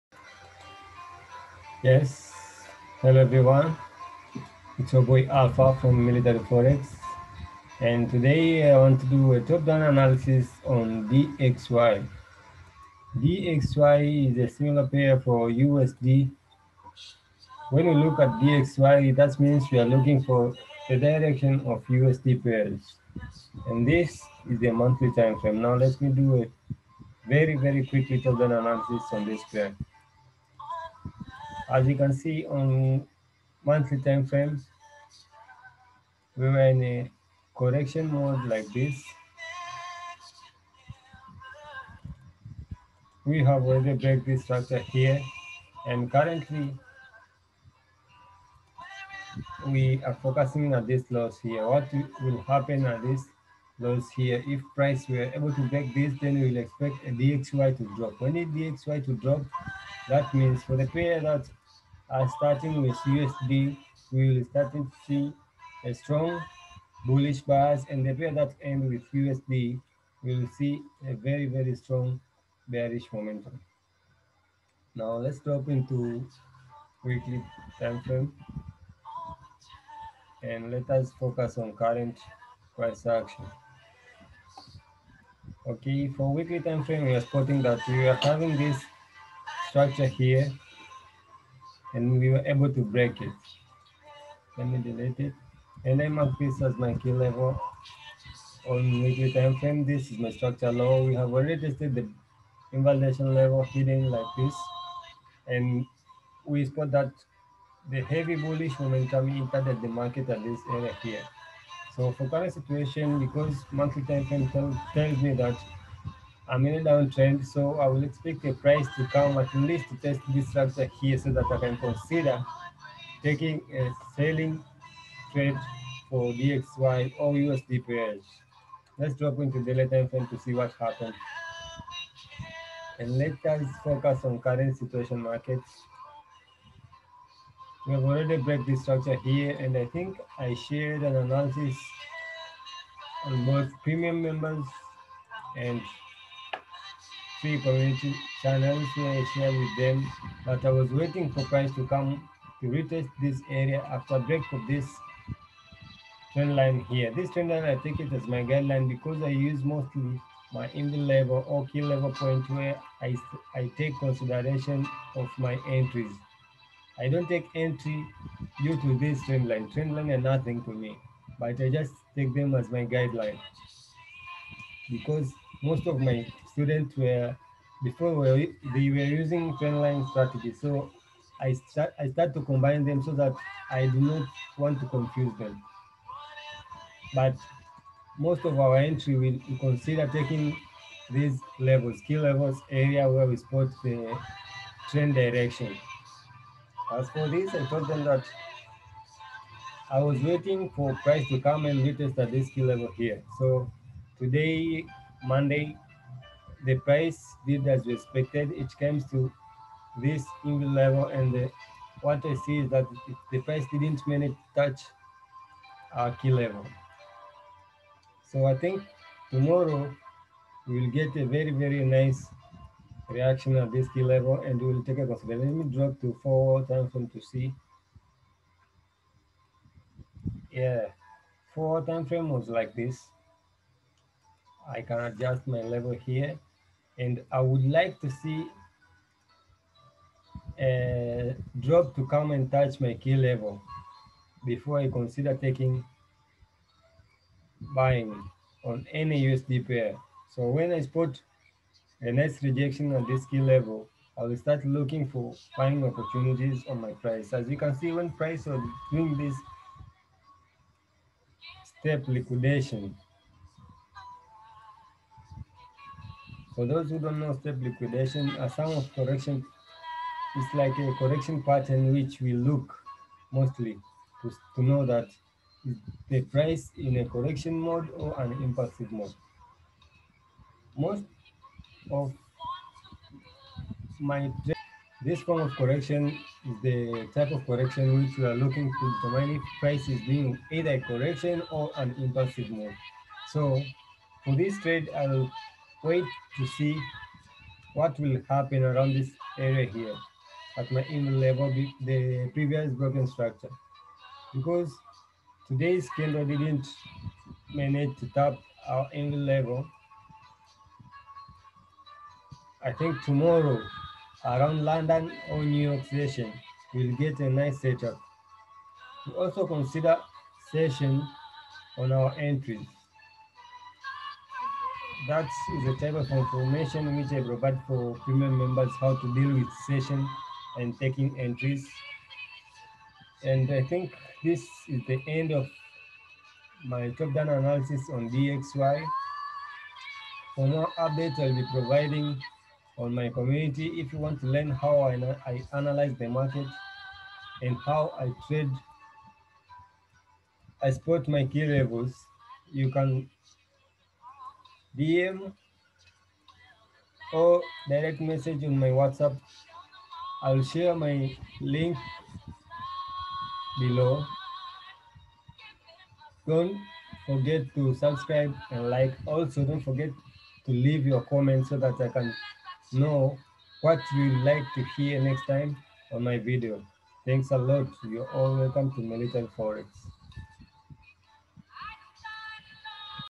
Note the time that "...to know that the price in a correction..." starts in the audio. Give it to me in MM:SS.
04:34.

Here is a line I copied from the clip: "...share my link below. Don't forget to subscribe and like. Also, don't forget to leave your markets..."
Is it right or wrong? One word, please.
wrong.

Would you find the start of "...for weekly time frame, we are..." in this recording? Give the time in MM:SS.
01:26.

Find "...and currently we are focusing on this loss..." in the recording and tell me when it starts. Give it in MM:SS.
00:45.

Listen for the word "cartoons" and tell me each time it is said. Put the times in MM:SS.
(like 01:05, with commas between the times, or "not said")
not said.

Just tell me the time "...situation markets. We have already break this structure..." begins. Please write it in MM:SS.
02:14.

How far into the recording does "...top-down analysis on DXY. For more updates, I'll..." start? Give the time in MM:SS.
05:36.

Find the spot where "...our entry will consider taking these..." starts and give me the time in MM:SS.
03:08.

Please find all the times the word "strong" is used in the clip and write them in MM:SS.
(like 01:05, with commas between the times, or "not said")
01:05, 01:11.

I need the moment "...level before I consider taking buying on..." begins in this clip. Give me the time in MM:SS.
04:03.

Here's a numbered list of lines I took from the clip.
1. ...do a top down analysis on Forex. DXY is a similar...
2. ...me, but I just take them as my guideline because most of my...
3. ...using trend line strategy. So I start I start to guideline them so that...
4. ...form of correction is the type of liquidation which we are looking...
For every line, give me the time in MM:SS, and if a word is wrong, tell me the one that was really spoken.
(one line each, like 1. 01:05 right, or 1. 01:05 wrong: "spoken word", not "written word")
1. 00:09 wrong: "DXY", not "Forex"
2. 02:50 right
3. 02:59 wrong: "combine", not "guideline"
4. 04:45 wrong: "correction", not "liquidation".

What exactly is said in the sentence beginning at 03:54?
I can adjust my level here.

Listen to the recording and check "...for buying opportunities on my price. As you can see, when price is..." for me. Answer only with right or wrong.
right.